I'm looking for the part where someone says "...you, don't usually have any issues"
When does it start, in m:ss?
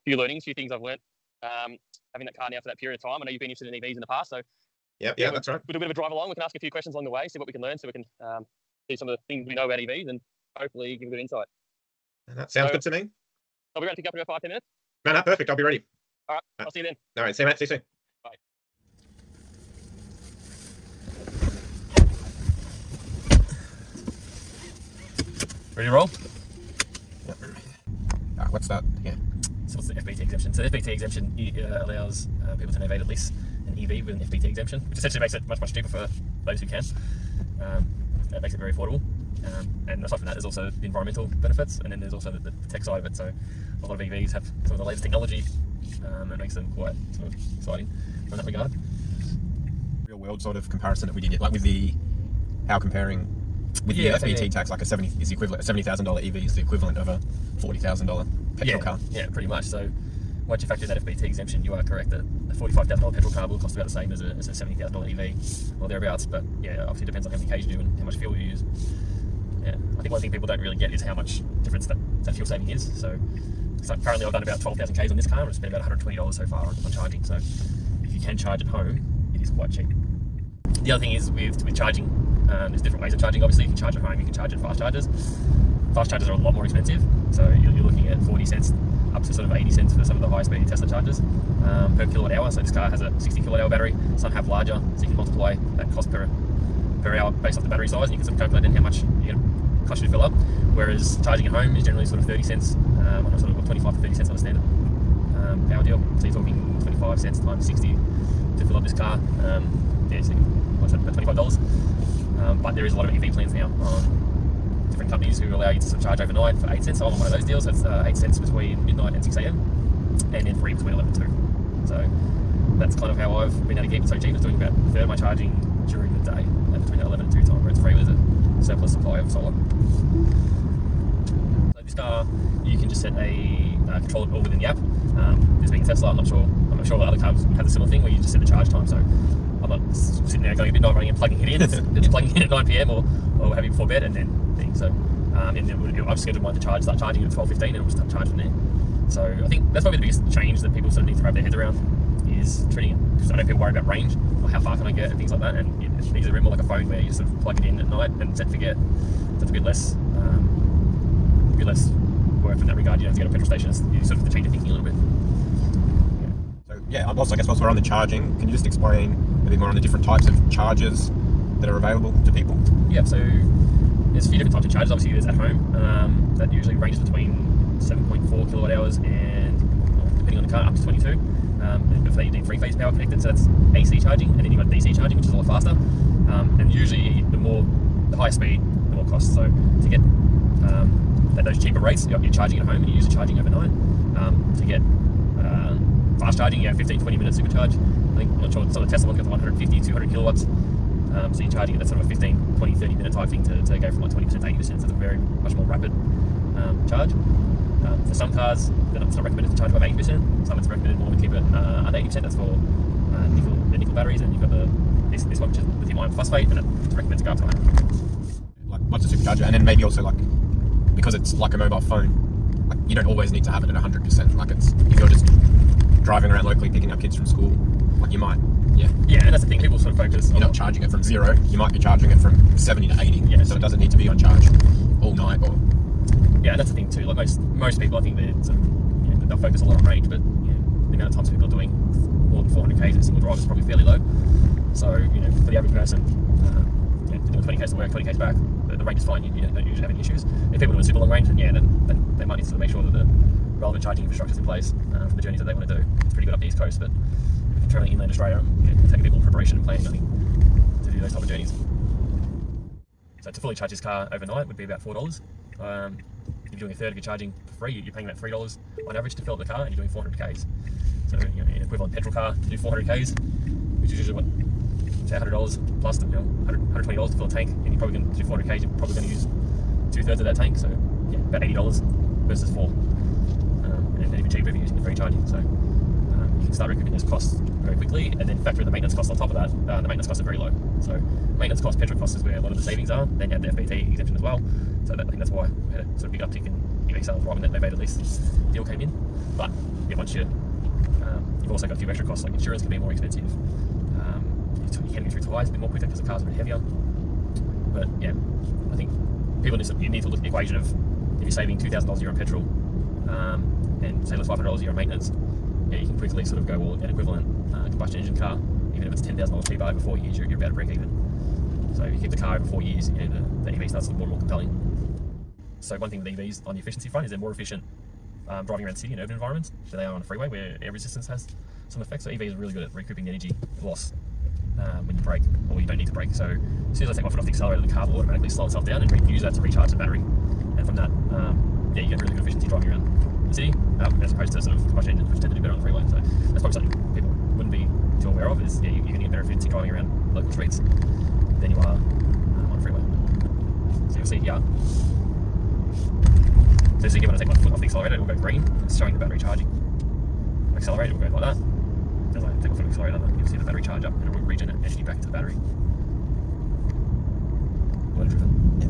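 4:09.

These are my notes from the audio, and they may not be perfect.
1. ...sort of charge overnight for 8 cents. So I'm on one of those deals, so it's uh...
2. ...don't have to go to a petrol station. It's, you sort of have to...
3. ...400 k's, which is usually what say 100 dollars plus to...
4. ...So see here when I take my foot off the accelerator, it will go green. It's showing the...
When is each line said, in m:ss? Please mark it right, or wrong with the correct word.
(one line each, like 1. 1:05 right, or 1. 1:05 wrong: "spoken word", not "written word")
1. 1:55 right
2. 2:43 right
3. 4:32 right
4. 5:56 right.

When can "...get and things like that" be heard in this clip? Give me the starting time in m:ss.
2:34.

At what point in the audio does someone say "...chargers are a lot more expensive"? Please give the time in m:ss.
1:26.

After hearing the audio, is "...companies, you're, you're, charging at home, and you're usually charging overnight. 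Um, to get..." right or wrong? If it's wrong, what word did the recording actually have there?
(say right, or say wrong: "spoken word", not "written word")
wrong: "rates", not "companies".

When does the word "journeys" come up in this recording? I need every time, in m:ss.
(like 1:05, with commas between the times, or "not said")
4:15, 4:21.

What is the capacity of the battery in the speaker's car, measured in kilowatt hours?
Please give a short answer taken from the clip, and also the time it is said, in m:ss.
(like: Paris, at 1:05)
60 kilowatt hours, at 1:33.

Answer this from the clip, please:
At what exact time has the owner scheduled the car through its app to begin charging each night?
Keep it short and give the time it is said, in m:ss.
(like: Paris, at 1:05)
12:15, at 2:27.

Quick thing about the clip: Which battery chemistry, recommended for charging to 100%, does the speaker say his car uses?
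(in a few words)
lithium ion phosphate.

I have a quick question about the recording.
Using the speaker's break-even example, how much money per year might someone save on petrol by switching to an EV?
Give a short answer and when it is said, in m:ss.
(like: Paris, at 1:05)
$2,000, at 5:11.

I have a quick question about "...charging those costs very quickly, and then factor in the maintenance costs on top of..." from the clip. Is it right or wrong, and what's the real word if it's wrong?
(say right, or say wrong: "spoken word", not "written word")
wrong: "recouping", not "charging".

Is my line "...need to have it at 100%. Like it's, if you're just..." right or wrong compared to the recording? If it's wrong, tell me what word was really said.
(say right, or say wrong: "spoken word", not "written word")
right.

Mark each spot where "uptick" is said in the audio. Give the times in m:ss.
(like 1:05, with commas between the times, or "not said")
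4:56.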